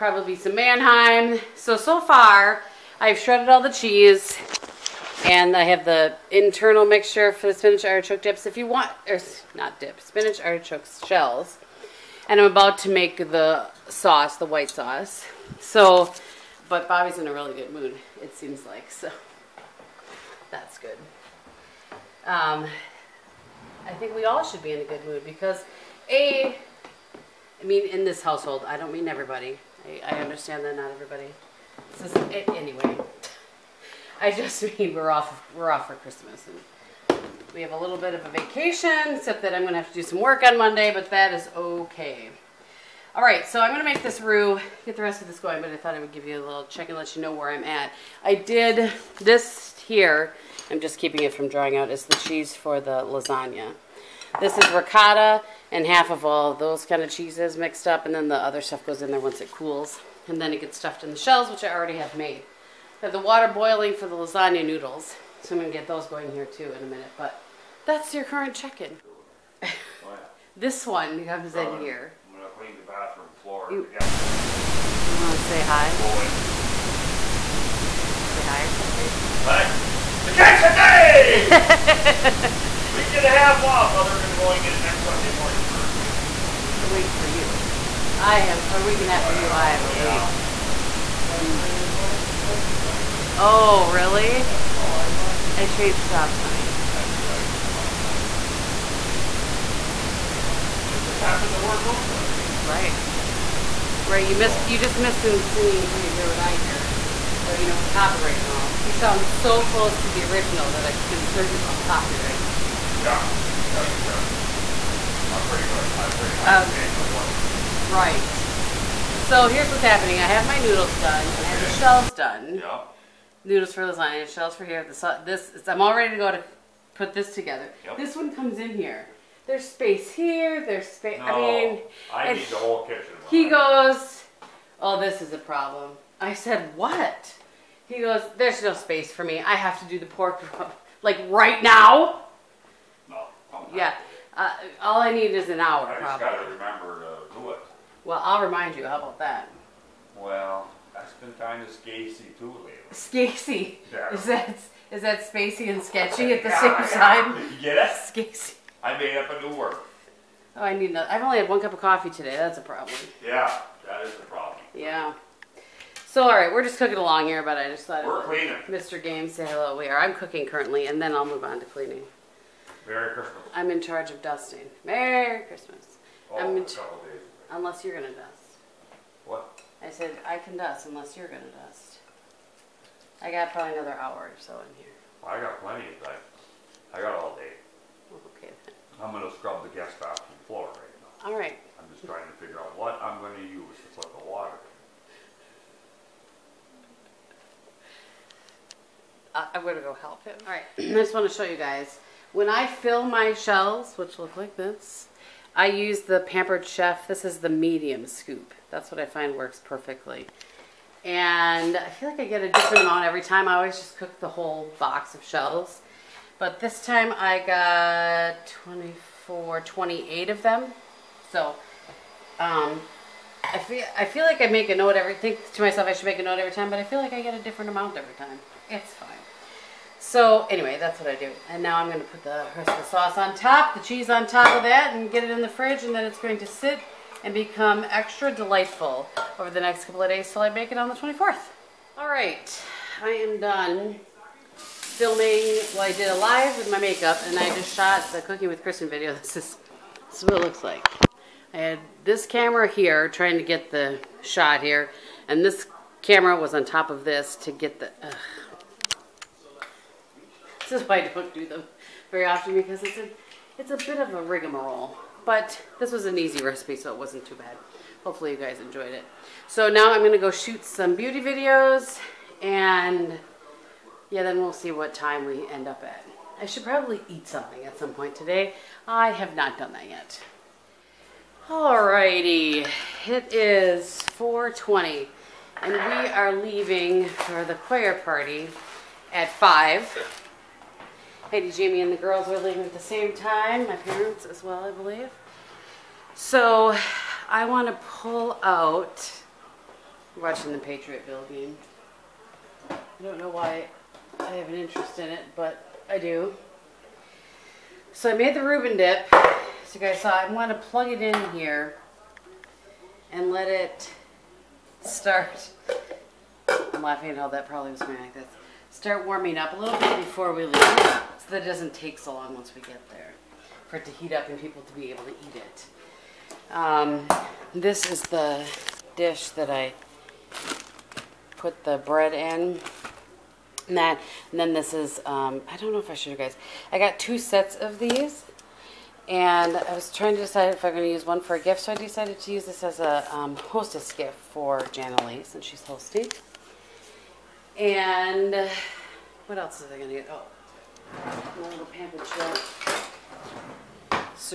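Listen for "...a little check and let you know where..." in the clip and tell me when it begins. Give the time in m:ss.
0:46.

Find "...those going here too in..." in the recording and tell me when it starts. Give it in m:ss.
1:05.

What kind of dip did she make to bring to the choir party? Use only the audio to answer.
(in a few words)
Reuben dip.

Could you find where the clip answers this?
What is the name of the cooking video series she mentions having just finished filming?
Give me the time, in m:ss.
4:08.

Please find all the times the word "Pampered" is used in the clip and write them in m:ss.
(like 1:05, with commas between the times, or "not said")
3:26, 5:51.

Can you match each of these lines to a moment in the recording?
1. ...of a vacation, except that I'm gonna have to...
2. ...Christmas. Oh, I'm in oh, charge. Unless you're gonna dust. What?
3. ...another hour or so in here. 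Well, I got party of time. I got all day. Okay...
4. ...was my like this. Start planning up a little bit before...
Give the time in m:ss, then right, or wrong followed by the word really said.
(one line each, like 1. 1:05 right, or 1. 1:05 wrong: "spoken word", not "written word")
1. 0:38 right
2. 2:55 right
3. 3:03 wrong: "plenty", not "party"
4. 5:17 wrong: "warming", not "planning".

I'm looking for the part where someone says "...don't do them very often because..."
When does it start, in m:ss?
4:21.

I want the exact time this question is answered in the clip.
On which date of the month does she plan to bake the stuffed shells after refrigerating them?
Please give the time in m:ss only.
4:00.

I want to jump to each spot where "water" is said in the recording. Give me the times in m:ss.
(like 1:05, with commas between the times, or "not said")
1:03, 3:14.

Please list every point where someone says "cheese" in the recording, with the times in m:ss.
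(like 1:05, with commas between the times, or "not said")
0:03, 0:52, 0:57, 3:53.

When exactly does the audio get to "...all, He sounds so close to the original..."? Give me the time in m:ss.
1:48.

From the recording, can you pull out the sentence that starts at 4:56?
So I want to pull out, I'm watching the Bill game.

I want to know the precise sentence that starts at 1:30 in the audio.
a week you're gonna play your plans and cookies right there.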